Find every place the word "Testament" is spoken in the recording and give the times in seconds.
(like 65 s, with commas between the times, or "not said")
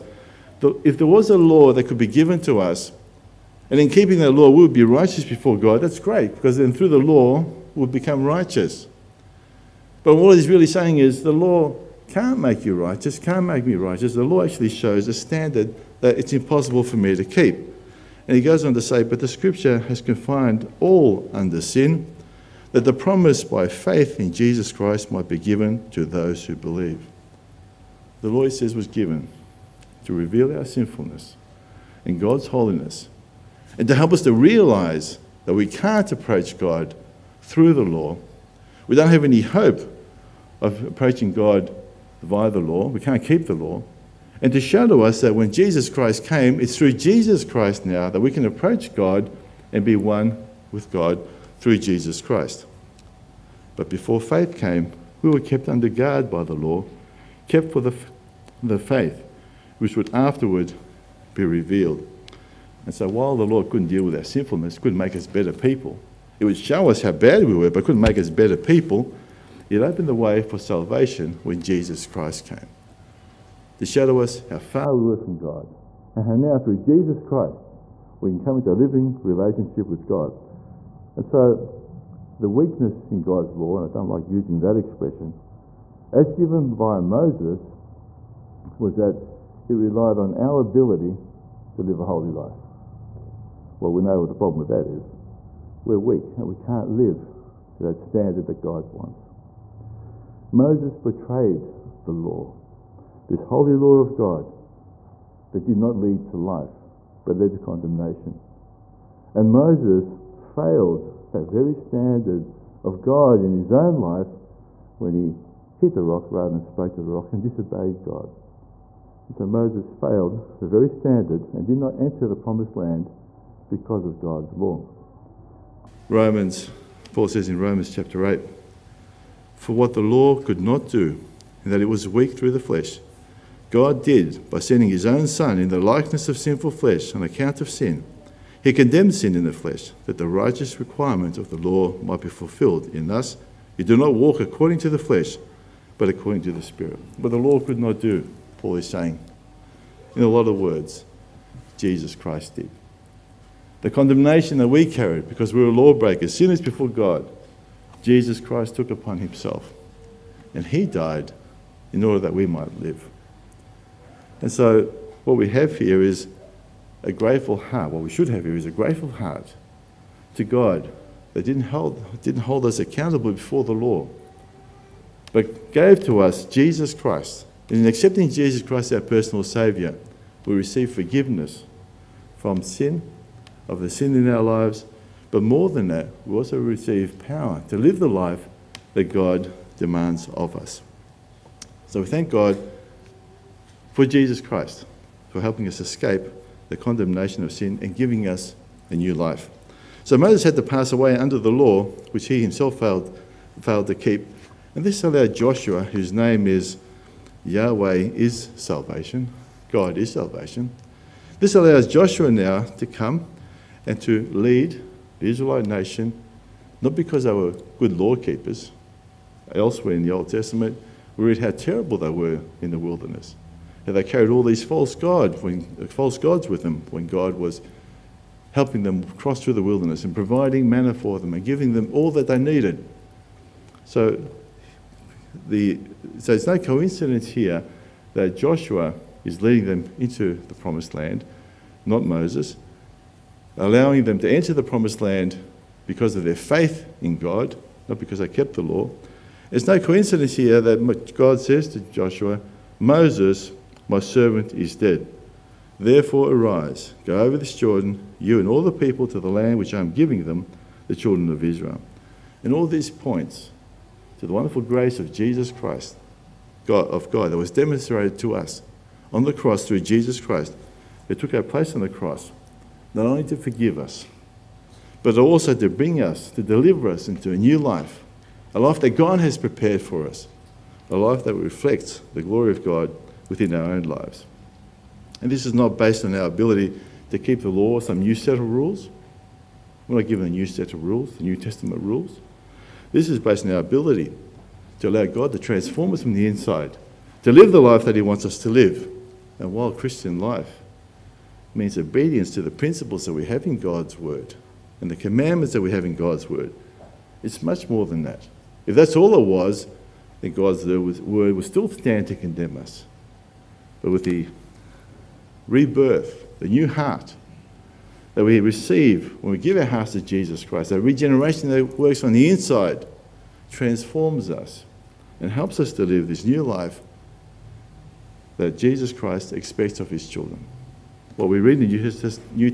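220 s, 291 s.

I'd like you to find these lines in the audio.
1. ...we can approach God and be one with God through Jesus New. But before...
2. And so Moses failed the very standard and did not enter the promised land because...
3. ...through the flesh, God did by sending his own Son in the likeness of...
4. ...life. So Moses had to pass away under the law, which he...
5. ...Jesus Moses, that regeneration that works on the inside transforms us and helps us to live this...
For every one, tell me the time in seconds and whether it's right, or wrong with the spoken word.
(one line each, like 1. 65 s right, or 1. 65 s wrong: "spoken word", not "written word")
1. 48 s wrong: "Christ", not "New"
2. 119 s right
3. 132 s right
4. 199 s right
5. 320 s wrong: "Christ", not "Moses".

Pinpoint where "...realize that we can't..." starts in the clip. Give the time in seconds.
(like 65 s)
34 s.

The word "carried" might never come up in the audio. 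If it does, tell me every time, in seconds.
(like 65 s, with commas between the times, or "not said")
154 s, 224 s.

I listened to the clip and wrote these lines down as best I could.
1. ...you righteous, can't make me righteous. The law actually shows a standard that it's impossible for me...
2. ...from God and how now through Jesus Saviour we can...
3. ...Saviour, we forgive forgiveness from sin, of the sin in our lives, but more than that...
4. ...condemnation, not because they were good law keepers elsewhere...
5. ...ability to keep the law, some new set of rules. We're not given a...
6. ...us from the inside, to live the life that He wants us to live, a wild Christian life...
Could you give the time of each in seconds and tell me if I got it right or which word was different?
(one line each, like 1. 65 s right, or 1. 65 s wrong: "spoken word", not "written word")
1. 12 s right
2. 75 s wrong: "Christ", not "Saviour"
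3. 179 s wrong: "receive", not "forgive"
4. 215 s wrong: "nation", not "condemnation"
5. 286 s right
6. 295 s right.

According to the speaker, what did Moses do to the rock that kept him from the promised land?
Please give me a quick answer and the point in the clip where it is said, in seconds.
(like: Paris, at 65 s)
Hit the rock, at 115 s.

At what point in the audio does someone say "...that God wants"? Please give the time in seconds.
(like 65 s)
98 s.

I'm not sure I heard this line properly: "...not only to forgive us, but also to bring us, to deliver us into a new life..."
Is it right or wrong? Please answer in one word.
right.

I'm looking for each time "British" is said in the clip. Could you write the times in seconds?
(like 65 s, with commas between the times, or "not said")
not said.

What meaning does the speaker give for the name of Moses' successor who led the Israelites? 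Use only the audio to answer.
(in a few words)
Yahweh is salvation.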